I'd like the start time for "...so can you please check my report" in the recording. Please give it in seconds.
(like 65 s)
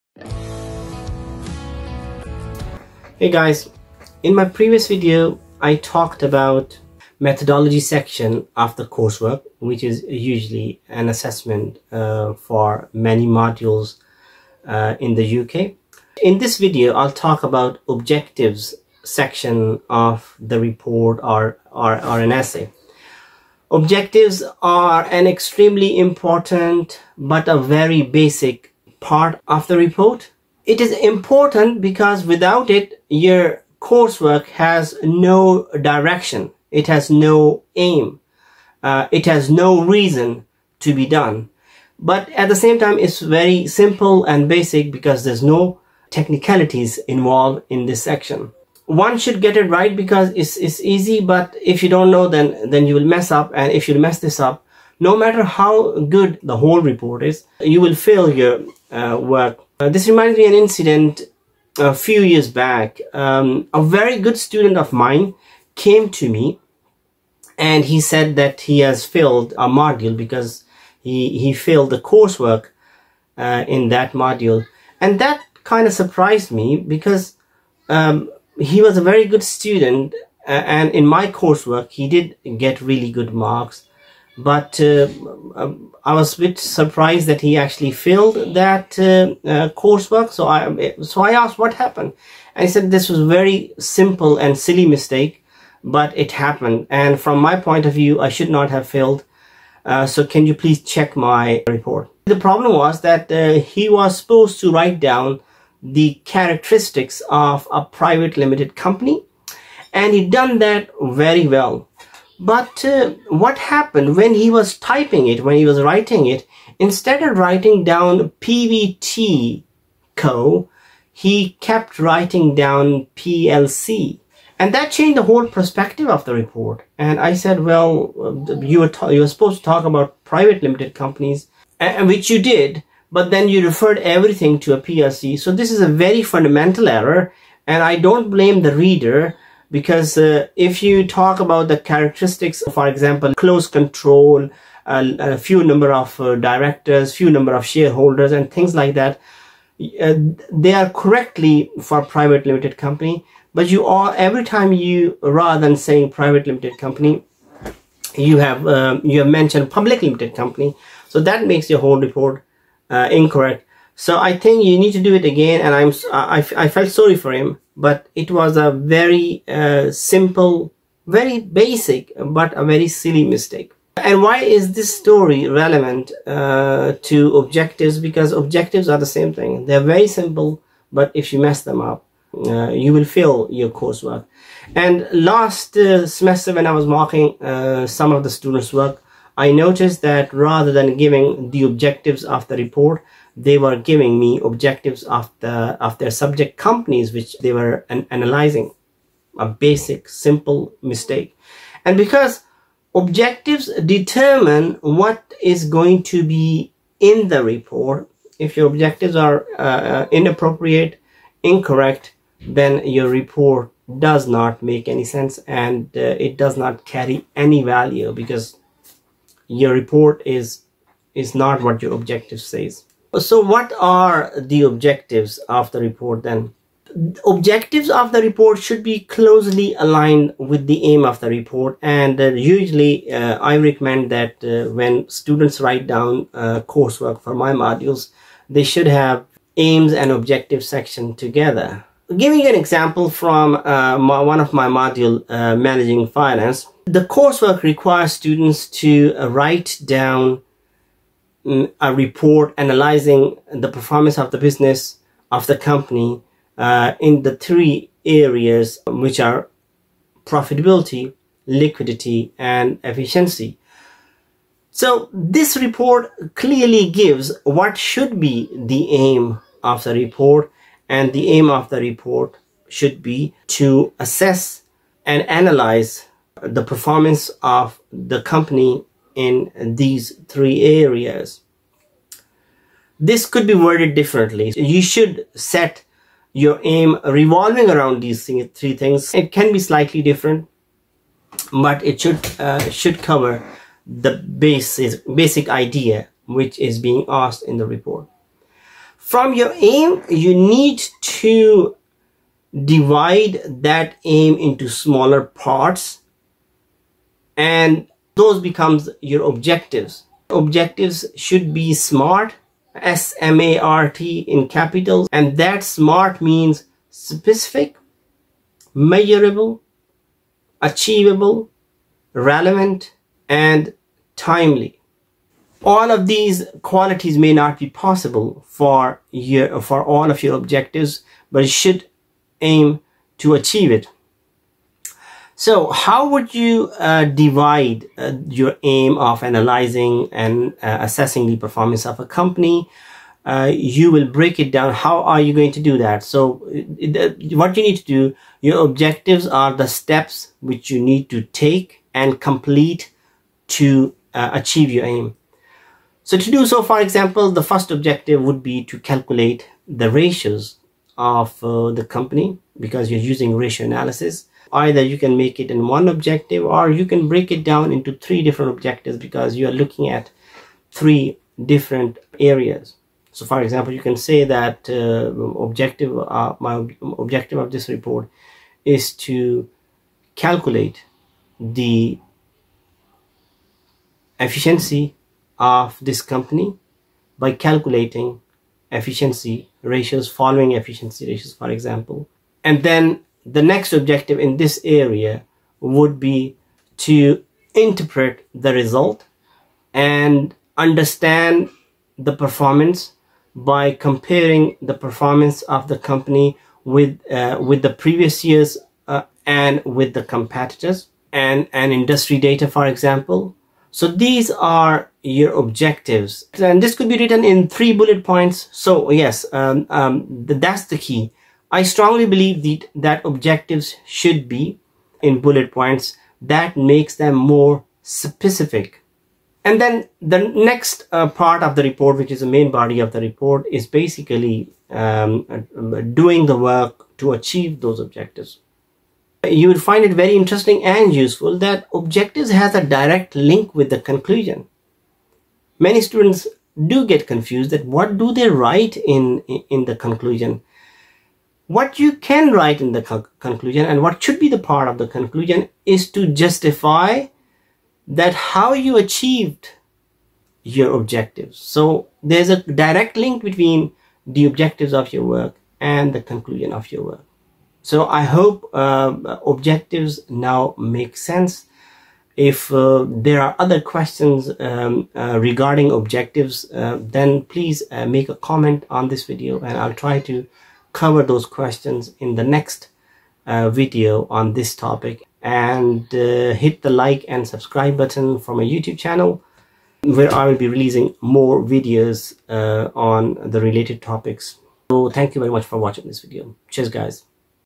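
100 s.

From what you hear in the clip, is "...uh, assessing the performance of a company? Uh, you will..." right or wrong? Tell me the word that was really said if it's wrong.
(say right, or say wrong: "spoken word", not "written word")
right.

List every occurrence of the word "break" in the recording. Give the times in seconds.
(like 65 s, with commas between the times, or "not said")
344 s, 367 s.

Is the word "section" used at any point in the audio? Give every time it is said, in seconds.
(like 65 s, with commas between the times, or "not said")
7 s, 19 s, 48 s, 240 s.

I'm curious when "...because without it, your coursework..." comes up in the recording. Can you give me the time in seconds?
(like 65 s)
31 s.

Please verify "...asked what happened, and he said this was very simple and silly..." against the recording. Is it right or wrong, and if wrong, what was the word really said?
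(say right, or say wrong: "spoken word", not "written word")
right.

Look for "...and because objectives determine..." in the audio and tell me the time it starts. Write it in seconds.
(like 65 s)
201 s.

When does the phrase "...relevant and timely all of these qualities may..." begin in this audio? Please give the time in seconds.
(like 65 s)
322 s.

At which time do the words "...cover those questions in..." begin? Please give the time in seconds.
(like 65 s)
480 s.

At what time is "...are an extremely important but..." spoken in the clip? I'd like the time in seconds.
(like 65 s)
24 s.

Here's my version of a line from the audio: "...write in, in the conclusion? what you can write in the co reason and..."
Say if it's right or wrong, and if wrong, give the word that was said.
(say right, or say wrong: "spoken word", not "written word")
wrong: "conclusion", not "reason".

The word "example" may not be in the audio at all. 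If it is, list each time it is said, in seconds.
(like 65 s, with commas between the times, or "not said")
142 s, 242 s, 356 s, 373 s, 391 s, 412 s.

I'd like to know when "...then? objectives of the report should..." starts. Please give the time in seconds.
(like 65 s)
226 s.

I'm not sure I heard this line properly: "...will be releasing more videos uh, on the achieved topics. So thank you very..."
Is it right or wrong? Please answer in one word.
wrong.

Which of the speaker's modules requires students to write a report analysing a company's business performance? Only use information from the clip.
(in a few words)
Managing finance.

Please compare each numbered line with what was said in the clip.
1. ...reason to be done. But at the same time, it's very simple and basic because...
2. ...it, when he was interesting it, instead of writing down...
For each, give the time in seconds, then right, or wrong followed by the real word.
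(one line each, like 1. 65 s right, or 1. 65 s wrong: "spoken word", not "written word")
1. 39 s right
2. 115 s wrong: "writing", not "interesting".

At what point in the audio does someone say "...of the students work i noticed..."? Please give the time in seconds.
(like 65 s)
188 s.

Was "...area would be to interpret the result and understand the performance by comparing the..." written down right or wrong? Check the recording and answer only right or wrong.
right.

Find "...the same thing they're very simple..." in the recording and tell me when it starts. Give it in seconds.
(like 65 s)
178 s.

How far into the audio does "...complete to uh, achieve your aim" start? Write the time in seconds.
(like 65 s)
352 s.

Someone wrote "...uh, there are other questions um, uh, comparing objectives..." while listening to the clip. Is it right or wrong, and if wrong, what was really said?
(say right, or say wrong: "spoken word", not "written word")
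wrong: "regarding", not "comparing".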